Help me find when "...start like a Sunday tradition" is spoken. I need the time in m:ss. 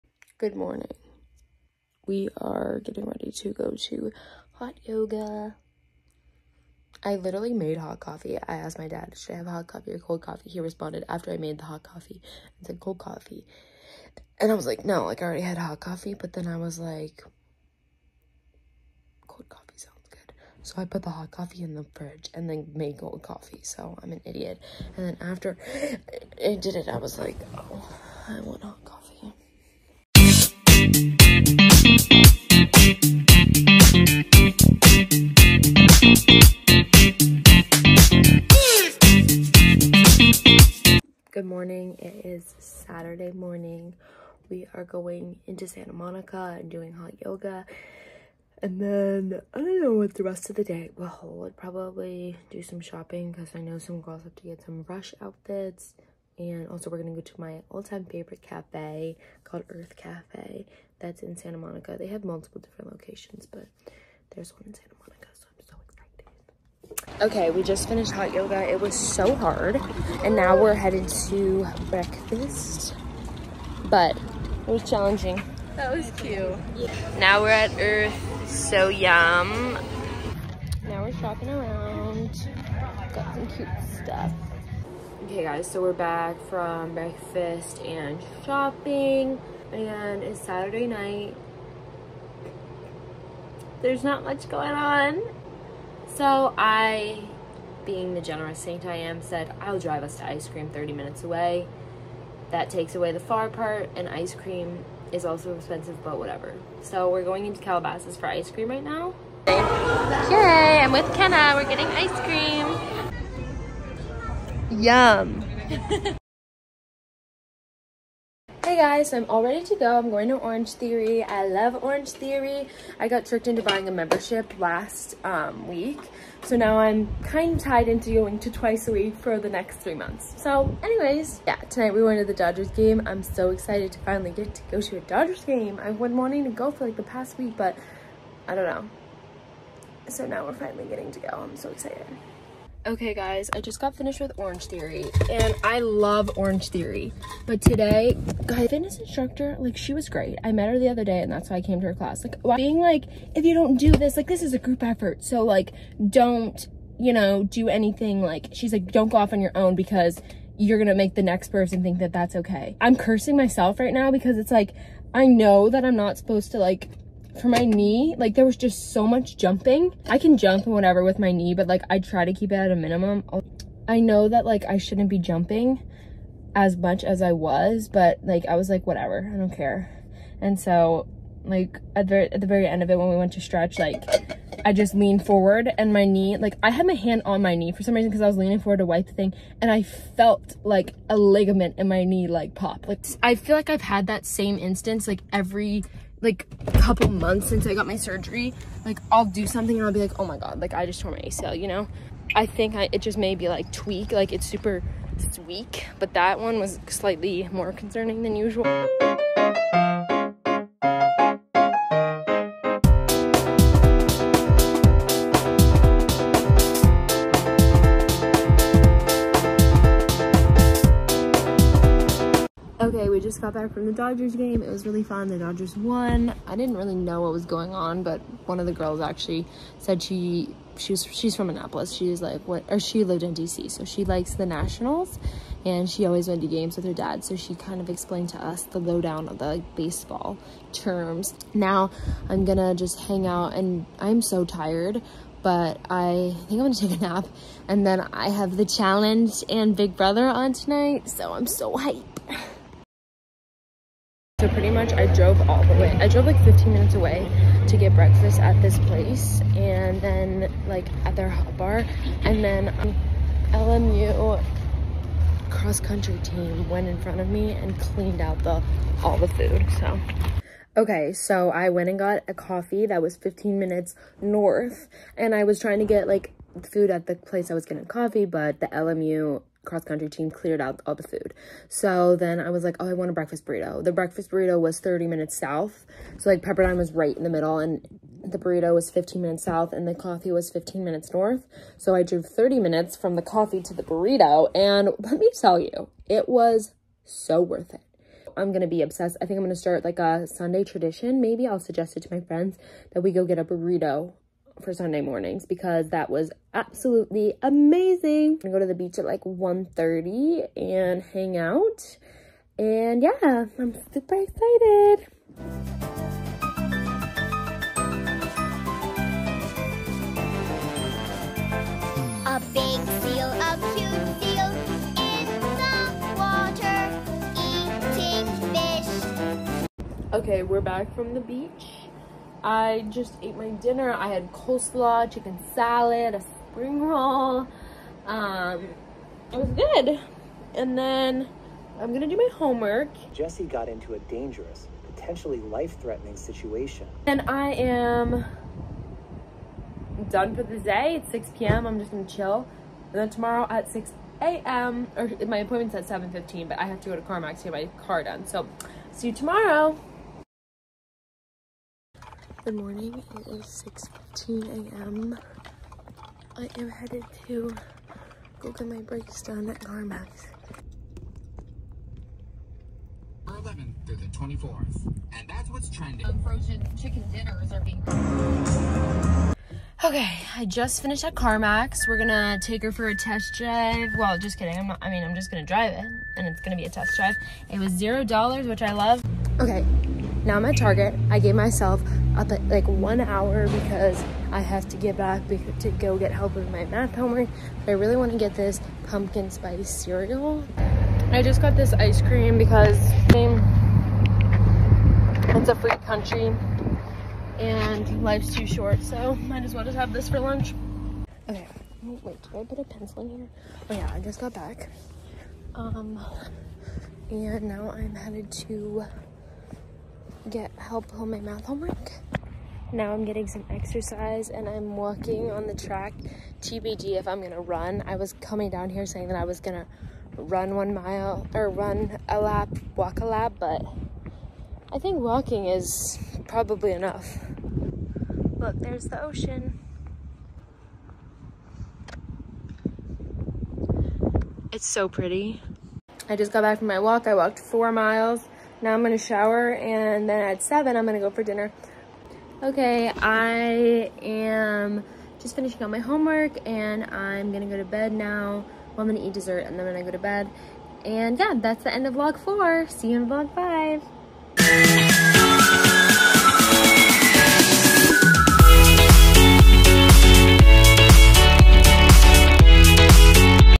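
4:59.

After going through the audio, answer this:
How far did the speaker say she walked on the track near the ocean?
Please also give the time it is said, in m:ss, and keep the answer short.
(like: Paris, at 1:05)
4 miles, at 7:27.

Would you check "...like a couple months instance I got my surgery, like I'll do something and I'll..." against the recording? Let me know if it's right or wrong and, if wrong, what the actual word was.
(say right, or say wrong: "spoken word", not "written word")
wrong: "since", not "instance".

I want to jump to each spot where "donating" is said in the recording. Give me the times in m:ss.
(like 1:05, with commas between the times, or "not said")
not said.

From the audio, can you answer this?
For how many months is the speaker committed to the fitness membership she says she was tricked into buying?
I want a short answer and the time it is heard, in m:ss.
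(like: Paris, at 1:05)
3, at 2:09.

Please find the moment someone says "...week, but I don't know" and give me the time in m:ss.
2:17.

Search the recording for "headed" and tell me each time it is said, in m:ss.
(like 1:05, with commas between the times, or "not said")
1:10, 6:06, 6:57.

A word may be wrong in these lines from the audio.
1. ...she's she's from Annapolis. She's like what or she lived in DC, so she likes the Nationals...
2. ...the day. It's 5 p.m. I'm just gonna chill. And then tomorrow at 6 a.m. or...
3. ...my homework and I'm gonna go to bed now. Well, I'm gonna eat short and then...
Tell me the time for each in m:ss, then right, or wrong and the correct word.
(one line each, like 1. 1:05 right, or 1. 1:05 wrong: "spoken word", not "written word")
1. 3:50 right
2. 5:50 wrong: "6", not "5"
3. 7:35 wrong: "dessert", not "short".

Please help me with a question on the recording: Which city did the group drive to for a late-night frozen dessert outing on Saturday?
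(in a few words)
Calabasas.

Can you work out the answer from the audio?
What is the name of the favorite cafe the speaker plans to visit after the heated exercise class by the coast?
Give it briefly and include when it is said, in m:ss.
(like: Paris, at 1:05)
Urth Caffé, at 0:59.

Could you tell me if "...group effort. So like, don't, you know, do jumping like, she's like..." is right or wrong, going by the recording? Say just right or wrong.
wrong.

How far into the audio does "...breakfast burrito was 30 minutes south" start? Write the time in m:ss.
4:43.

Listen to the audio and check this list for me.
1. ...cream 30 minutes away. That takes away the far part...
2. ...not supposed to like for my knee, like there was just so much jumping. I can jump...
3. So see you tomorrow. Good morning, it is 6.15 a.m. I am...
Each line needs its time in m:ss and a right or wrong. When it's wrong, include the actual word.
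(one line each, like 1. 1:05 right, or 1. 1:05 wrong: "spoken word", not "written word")
1. 1:40 right
2. 2:45 right
3. 5:58 right.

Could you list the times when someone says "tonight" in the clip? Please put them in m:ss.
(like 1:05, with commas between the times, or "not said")
2:11, 4:10.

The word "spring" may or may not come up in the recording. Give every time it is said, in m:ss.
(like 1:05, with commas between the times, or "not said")
5:36.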